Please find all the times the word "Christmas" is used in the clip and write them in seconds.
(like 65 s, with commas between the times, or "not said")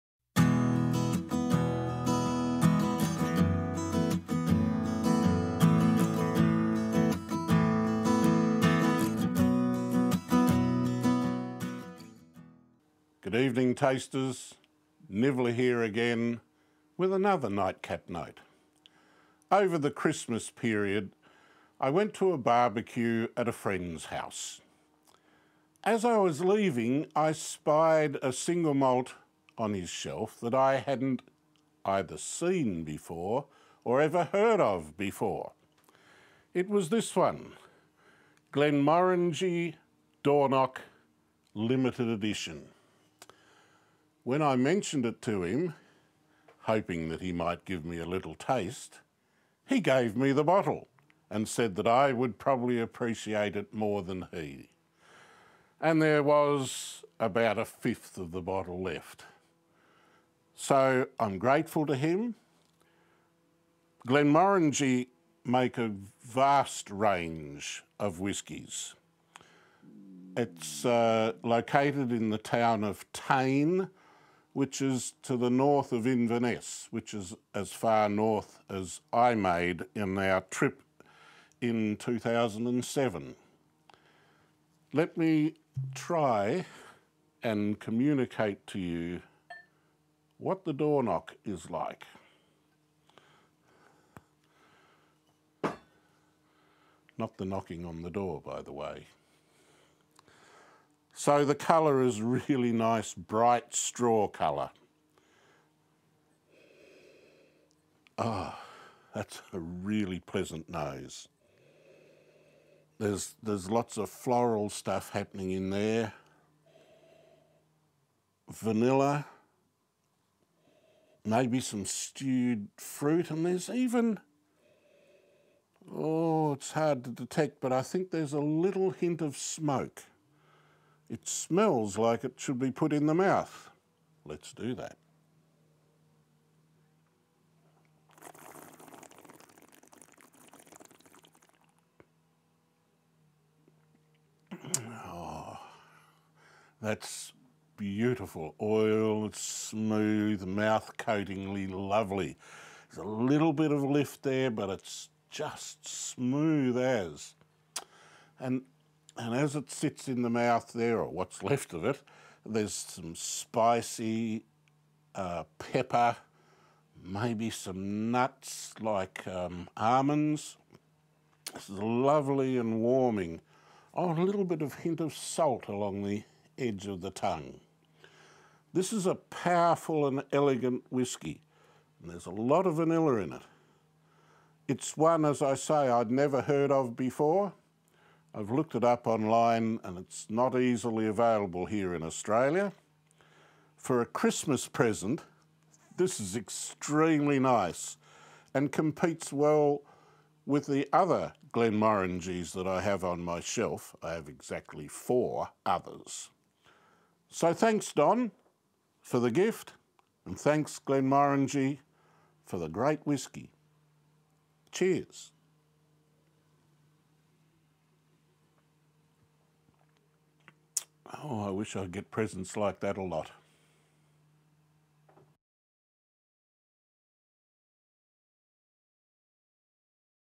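19 s, 194 s.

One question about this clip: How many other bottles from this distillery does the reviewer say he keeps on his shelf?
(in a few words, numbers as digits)
4.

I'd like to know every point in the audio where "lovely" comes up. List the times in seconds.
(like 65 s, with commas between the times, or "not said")
151 s, 171 s.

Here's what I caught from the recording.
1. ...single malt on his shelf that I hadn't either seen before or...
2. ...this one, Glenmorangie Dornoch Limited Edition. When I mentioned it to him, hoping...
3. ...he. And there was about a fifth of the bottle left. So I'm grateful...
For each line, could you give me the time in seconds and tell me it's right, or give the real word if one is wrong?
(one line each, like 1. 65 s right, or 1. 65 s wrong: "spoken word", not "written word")
1. 28 s right
2. 36 s right
3. 54 s right.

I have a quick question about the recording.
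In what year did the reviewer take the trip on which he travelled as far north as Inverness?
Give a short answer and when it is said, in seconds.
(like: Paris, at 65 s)
2007, at 81 s.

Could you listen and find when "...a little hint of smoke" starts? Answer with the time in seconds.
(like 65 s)
128 s.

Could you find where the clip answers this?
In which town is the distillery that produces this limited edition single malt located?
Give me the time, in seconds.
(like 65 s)
73 s.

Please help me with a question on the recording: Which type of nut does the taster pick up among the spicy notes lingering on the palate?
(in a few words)
Almonds.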